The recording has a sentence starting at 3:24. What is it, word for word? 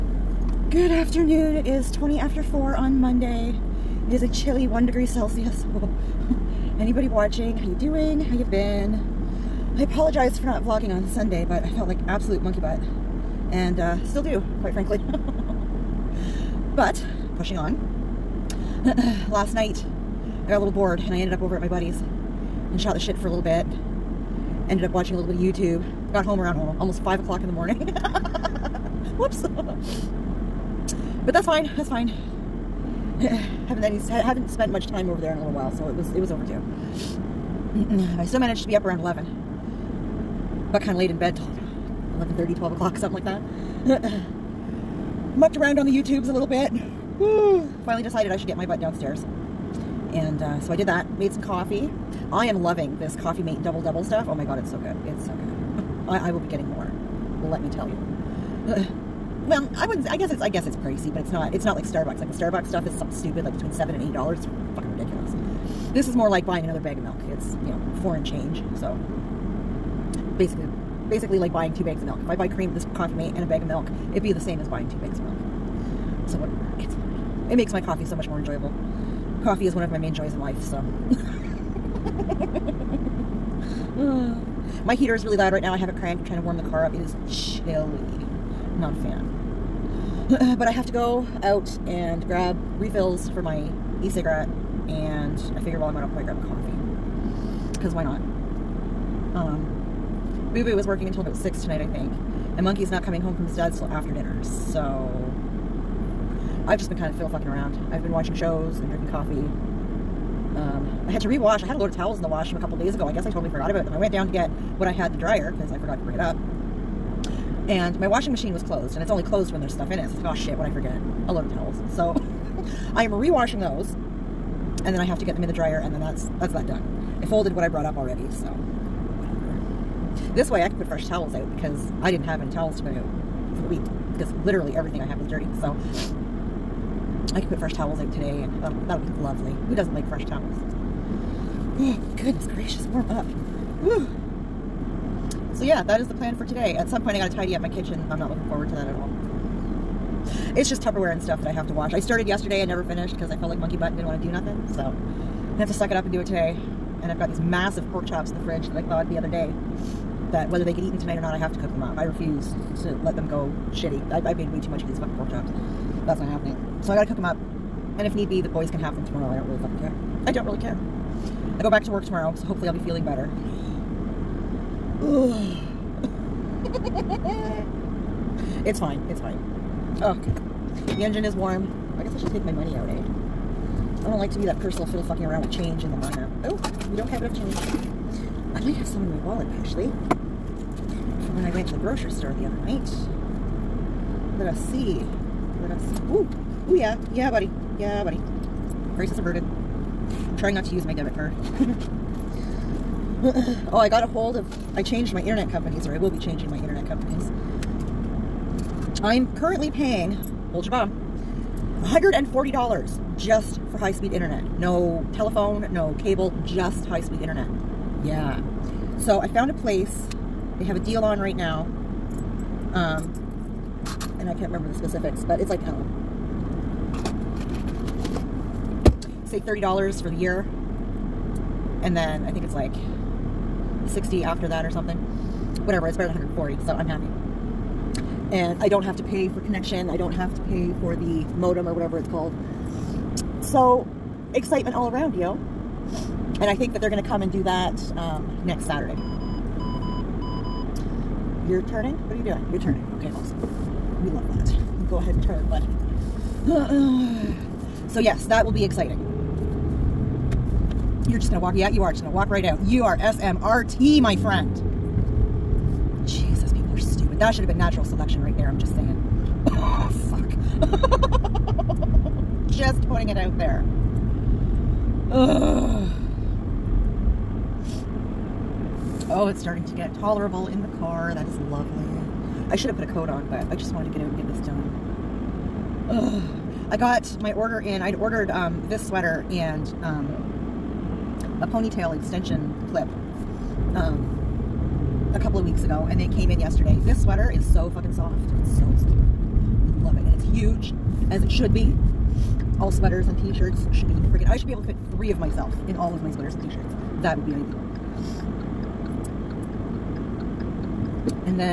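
I changed my internet companies, or I will be changing my internet companies.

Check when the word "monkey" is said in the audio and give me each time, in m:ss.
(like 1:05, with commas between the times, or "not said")
0:12, 1:42, 2:33.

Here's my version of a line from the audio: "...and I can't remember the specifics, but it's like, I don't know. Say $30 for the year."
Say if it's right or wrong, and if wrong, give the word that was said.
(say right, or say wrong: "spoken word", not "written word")
right.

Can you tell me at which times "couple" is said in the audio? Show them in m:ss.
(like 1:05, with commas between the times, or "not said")
1:52, 4:55.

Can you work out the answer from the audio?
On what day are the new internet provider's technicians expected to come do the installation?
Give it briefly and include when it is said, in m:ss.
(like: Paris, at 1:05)
next Saturday, at 4:08.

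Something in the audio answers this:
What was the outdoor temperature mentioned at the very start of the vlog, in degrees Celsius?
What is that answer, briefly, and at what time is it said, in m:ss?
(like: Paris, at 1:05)
1 degree Celsius, at 0:04.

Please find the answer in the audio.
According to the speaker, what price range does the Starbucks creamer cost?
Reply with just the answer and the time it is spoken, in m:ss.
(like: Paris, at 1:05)
between 7 and 8 dollars, at 1:03.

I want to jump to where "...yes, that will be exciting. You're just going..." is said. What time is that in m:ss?
4:17.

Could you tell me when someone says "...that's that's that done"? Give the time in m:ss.
2:06.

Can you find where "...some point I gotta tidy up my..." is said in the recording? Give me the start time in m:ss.
2:26.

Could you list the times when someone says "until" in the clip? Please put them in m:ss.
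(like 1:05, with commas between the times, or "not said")
1:41.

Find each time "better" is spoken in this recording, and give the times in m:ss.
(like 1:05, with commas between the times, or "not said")
2:53, 3:55.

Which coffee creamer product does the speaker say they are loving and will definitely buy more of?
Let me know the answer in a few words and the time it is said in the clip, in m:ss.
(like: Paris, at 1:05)
Coffee Mate Double Double, at 0:53.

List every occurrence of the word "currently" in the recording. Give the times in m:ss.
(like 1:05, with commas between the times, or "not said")
3:29.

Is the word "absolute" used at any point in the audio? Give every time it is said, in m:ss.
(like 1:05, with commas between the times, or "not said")
0:12.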